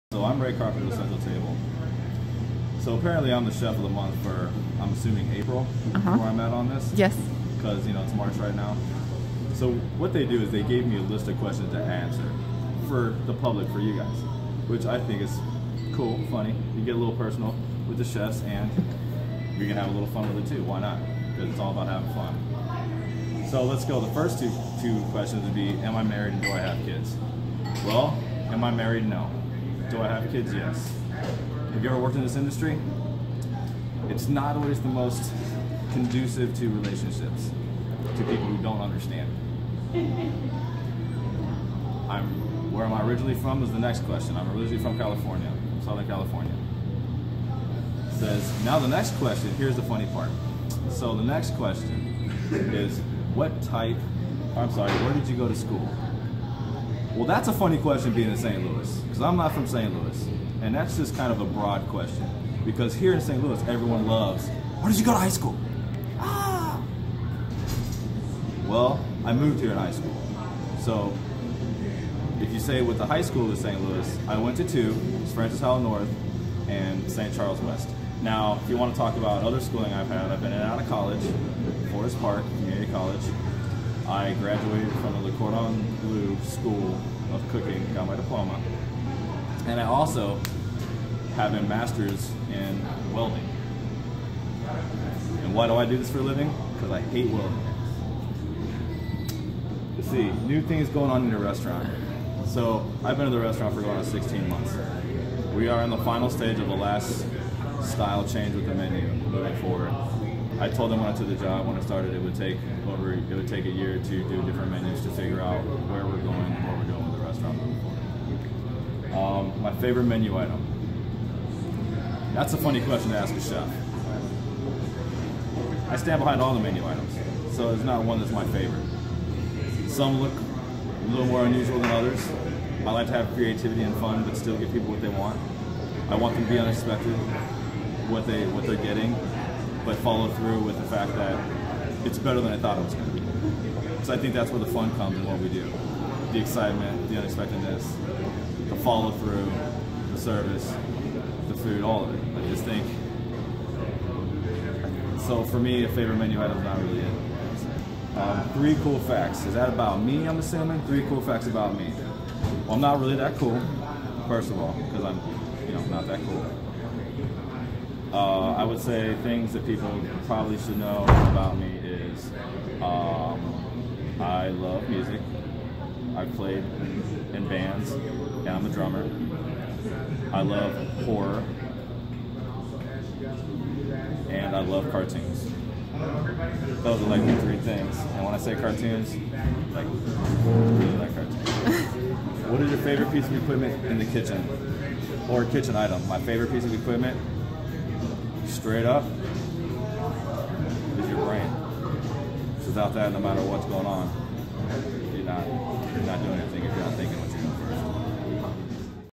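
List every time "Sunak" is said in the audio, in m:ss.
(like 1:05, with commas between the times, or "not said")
not said.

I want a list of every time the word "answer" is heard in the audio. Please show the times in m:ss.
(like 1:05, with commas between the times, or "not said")
0:12.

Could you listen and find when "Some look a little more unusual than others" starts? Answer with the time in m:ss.
2:09.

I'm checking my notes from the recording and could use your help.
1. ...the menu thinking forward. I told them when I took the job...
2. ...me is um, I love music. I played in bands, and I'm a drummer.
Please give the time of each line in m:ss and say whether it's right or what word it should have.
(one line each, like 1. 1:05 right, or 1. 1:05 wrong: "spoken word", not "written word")
1. 1:48 wrong: "moving", not "thinking"
2. 2:51 right.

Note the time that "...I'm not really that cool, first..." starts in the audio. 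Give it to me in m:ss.
2:42.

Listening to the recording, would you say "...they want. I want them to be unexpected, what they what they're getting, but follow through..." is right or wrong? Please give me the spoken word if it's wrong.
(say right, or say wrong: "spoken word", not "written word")
right.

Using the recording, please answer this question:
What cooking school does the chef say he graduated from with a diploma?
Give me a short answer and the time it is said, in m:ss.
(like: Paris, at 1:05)
Cordon Bleu School of Cooking, at 1:25.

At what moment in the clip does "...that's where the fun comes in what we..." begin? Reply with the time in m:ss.
2:24.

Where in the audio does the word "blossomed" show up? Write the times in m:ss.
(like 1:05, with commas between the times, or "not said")
not said.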